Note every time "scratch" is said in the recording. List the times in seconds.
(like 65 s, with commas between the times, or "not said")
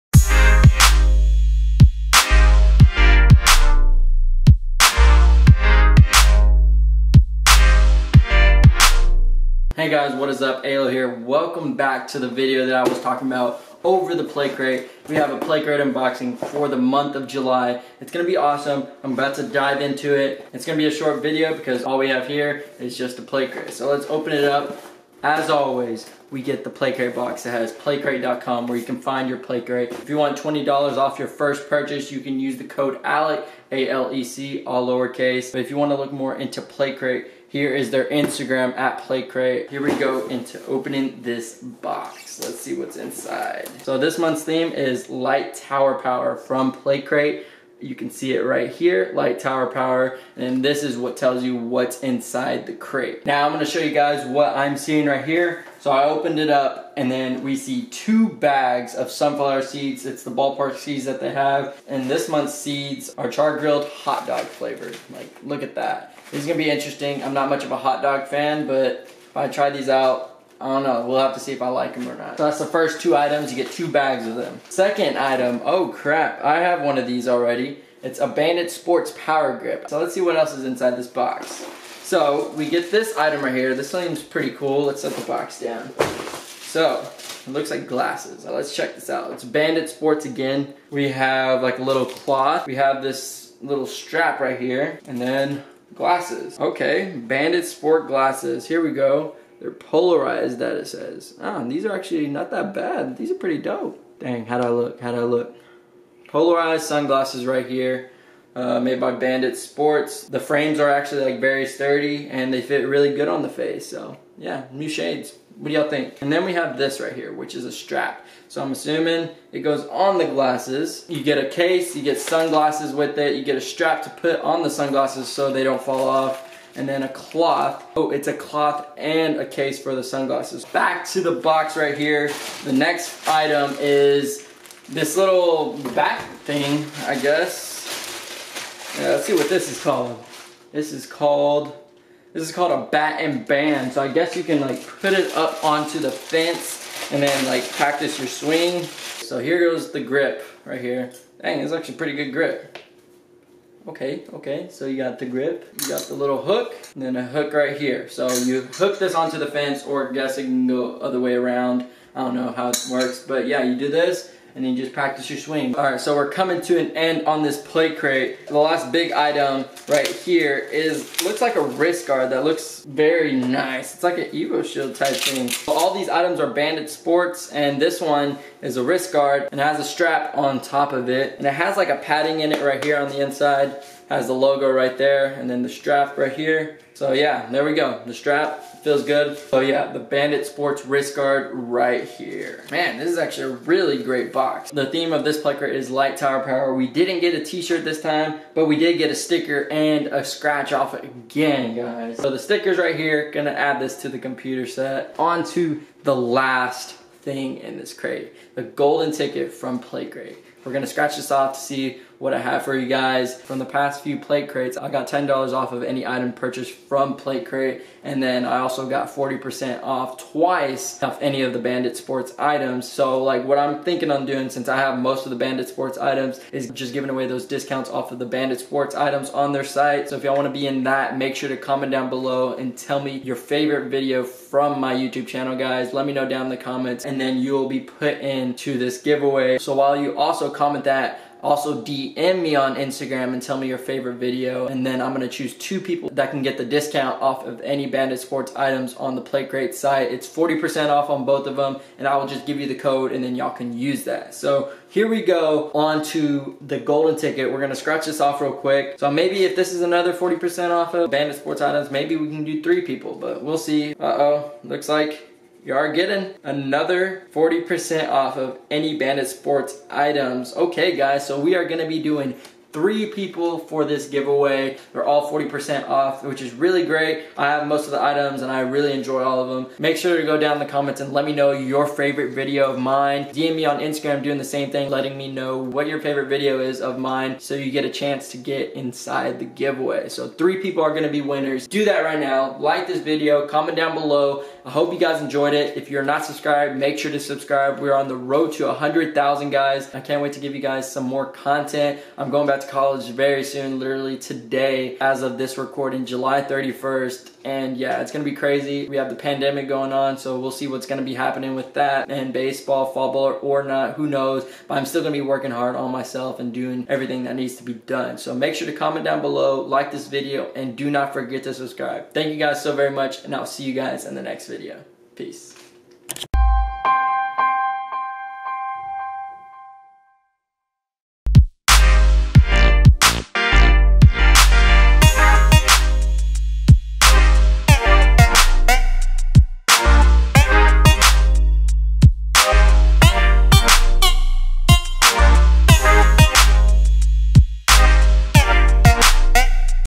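200 s, 210 s, 257 s.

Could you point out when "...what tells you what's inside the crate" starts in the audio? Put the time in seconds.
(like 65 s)
50 s.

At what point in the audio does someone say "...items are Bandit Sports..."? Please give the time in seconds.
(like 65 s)
176 s.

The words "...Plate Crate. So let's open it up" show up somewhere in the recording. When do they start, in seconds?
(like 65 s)
23 s.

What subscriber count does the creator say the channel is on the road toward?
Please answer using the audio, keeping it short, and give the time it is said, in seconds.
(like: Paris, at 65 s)
100,000, at 298 s.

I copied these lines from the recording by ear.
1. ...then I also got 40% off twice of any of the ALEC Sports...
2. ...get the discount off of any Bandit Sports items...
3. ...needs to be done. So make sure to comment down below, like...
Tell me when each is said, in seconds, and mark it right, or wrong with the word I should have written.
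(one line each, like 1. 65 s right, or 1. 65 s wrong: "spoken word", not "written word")
1. 218 s wrong: "Bandit", not "ALEC"
2. 246 s right
3. 317 s right.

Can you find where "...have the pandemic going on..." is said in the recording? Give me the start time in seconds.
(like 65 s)
308 s.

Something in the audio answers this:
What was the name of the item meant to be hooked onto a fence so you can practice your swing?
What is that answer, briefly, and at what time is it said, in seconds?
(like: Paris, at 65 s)
Bat and band, at 142 s.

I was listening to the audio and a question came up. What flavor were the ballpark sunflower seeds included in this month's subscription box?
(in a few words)
Char grilled hot dog.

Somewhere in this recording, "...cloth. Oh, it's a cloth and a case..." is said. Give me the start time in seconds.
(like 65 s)
127 s.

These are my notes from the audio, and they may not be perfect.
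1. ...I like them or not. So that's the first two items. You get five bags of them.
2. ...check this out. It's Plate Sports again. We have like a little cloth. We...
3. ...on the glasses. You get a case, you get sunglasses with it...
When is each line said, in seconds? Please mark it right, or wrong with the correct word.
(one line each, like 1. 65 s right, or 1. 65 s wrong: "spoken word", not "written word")
1. 71 s wrong: "two", not "five"
2. 88 s wrong: "Bandit", not "Plate"
3. 119 s right.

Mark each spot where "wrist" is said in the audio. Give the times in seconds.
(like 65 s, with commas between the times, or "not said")
171 s, 178 s, 190 s.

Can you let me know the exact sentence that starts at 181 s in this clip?
And it has like a padding in it right here on the inside.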